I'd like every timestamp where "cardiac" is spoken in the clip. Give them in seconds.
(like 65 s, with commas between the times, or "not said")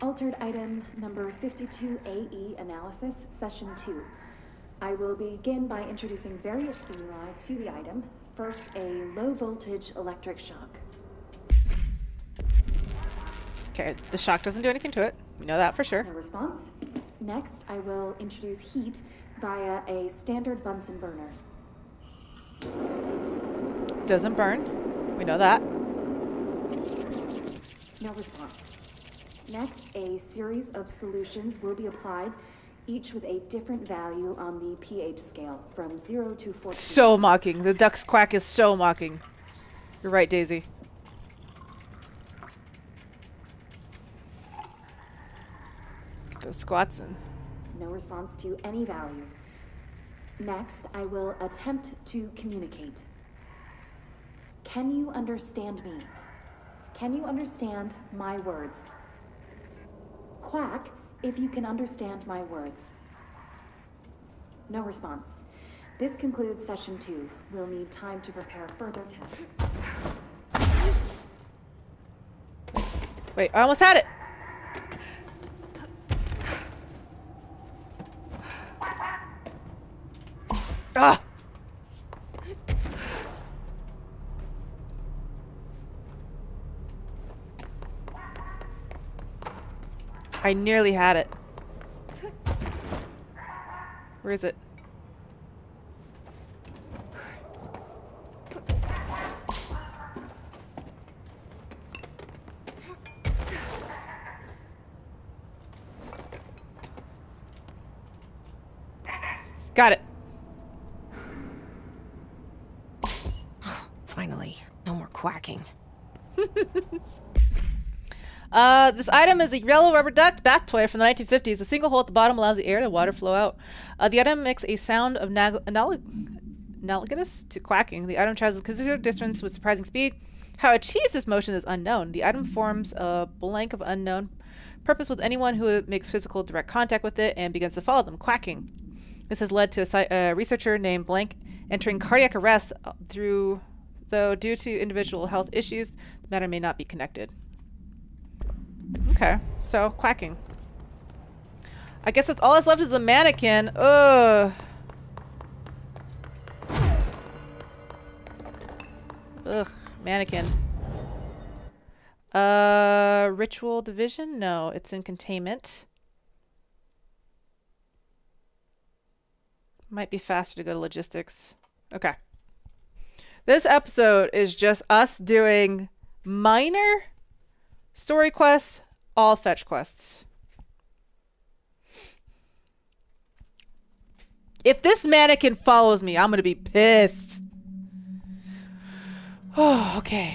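141 s.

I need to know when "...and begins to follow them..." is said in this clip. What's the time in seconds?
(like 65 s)
137 s.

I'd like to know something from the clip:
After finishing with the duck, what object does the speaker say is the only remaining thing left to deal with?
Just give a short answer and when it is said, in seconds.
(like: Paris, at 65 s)
The mannequin, at 152 s.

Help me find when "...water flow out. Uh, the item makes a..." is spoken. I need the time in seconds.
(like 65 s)
122 s.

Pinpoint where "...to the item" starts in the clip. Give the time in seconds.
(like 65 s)
7 s.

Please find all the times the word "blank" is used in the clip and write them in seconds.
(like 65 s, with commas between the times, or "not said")
133 s, 141 s.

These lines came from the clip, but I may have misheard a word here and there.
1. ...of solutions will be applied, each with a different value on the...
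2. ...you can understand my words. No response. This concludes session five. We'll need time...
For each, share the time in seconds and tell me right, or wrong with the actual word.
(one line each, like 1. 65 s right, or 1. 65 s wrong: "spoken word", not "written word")
1. 30 s right
2. 61 s wrong: "two", not "five".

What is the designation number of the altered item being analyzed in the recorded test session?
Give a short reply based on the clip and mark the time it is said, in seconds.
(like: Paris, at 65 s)
52AE, at 1 s.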